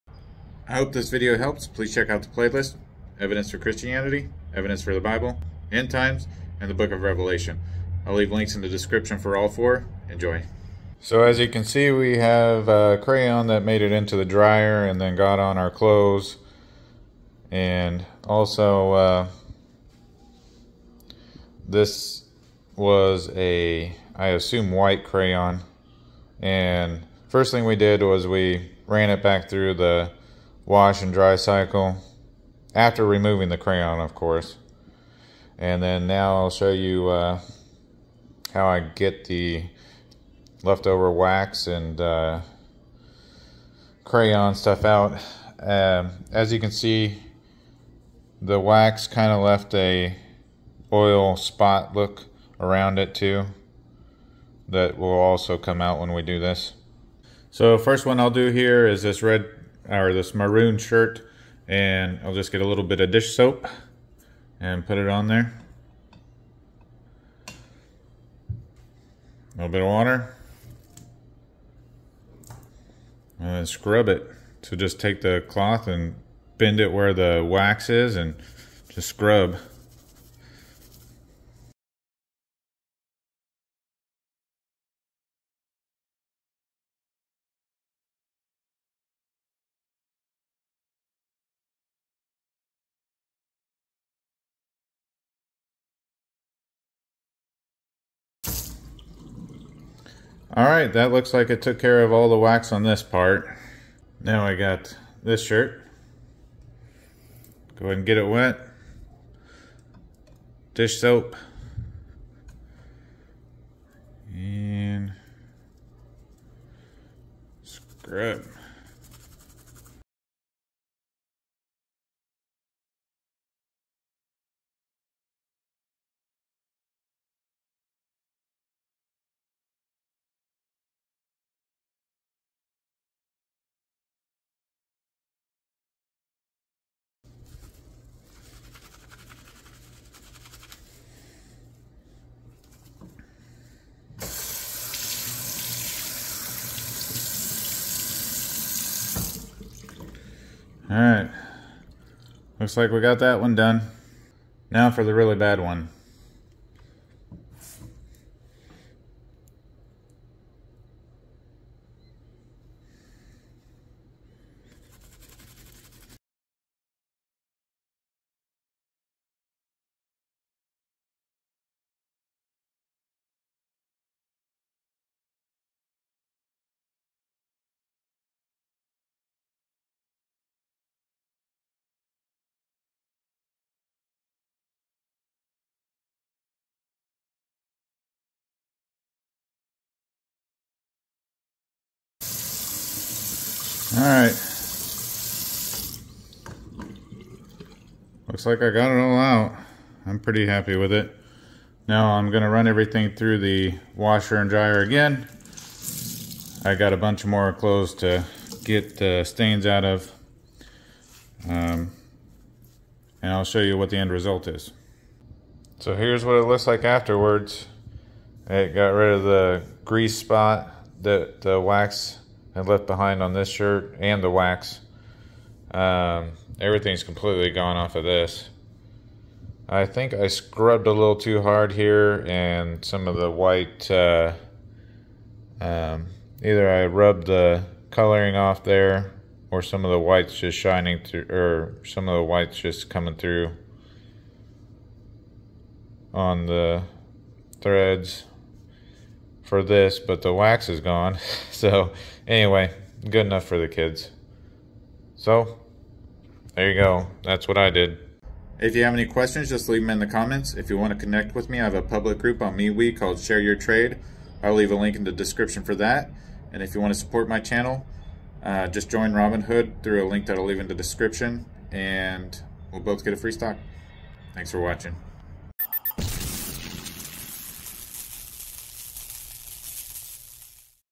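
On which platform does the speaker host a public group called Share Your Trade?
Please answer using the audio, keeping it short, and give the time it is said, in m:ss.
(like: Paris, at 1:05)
MeWe, at 4:22.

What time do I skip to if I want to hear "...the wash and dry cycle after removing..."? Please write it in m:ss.
0:29.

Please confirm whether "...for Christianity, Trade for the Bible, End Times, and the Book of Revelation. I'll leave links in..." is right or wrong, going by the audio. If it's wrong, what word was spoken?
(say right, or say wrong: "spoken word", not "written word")
wrong: "Evidence", not "Trade".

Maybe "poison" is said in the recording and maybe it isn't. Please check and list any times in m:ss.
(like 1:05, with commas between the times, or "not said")
not said.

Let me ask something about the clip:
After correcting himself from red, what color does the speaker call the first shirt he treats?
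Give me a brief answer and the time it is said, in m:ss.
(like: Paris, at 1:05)
Maroon, at 1:00.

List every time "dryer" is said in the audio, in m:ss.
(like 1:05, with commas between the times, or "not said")
0:14, 3:24.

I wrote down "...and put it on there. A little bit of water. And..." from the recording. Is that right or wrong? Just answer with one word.
right.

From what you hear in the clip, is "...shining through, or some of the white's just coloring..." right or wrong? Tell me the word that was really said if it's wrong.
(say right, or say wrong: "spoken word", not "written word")
wrong: "coming", not "coloring".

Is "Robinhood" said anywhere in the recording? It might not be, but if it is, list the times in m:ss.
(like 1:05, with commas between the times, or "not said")
4:29.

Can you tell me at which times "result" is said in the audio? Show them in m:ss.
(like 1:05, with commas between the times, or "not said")
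3:34.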